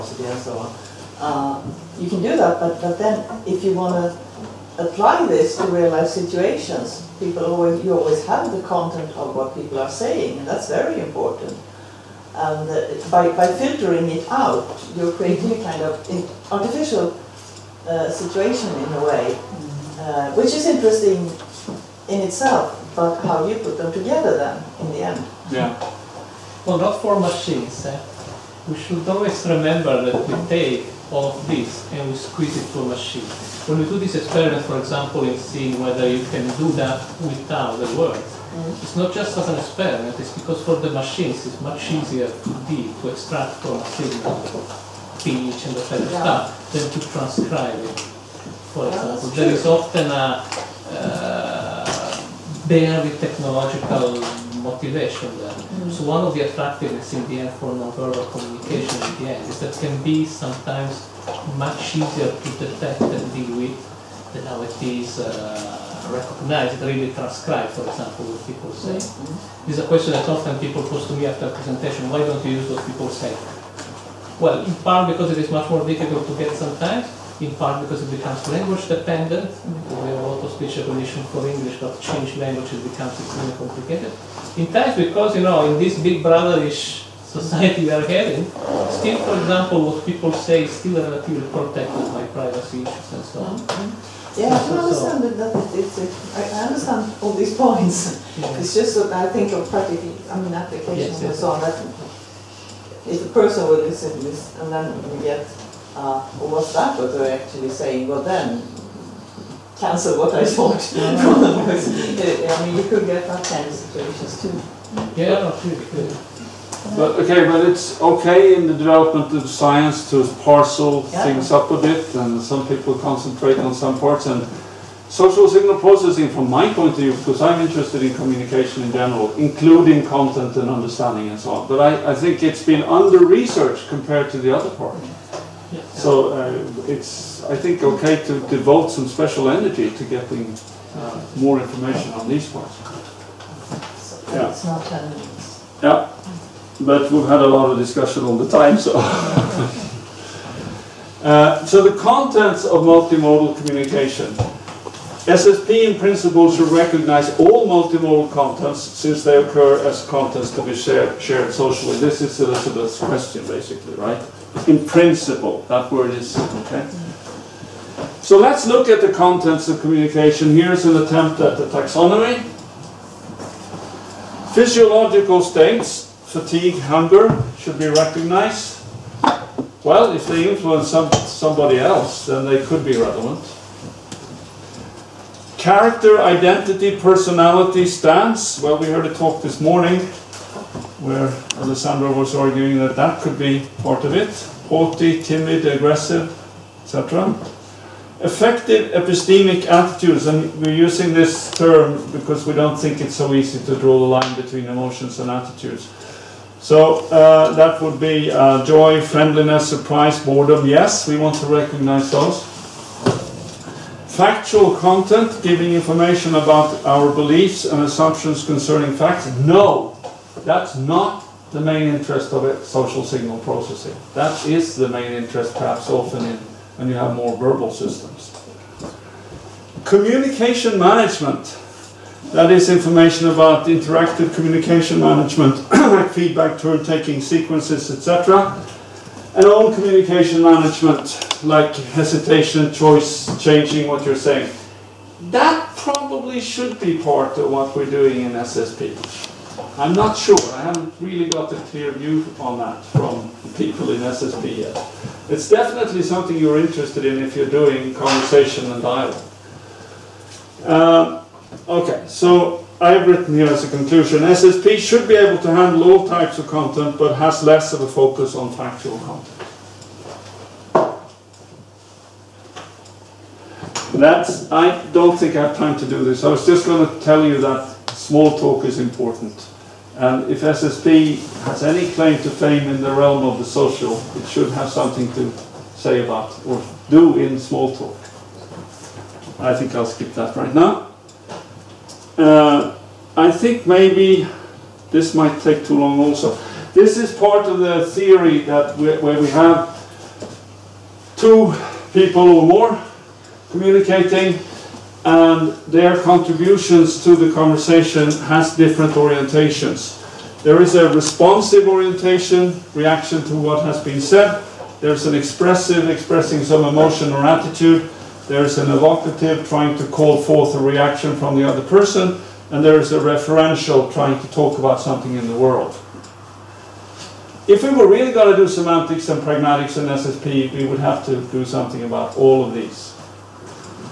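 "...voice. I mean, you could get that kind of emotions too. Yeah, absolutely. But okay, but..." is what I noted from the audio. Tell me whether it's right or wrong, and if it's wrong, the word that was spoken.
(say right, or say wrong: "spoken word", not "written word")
wrong: "situations", not "emotions".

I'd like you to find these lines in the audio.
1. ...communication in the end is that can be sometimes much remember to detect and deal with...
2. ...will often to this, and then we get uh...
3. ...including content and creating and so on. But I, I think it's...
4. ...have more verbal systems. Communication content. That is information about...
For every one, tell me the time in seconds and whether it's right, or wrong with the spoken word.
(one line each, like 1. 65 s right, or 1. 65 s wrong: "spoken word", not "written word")
1. 58 s wrong: "easier", not "remember"
2. 103 s wrong: "listen", not "often"
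3. 129 s wrong: "understanding", not "creating"
4. 226 s wrong: "management", not "content".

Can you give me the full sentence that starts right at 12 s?
And uh, by, by filtering it out, you're creating a kind of artificial uh, situation in a way, mm-hmm.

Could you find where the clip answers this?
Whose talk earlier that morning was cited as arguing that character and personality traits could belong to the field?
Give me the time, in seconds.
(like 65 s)
191 s.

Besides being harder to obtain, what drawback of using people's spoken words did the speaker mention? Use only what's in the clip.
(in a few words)
language dependent.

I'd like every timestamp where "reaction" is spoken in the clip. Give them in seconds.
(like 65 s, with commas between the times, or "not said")
312 s, 320 s.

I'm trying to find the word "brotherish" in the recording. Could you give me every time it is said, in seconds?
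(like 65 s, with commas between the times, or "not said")
86 s.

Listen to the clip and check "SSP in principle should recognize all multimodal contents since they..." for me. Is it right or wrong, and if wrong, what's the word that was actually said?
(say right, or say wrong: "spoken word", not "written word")
right.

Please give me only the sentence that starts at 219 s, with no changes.
No, that's not the main interest of it, social signal processing.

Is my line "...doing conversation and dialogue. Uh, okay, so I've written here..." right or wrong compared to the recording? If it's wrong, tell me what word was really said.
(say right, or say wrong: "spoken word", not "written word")
right.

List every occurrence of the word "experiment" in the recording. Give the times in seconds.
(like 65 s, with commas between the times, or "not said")
34 s, 39 s.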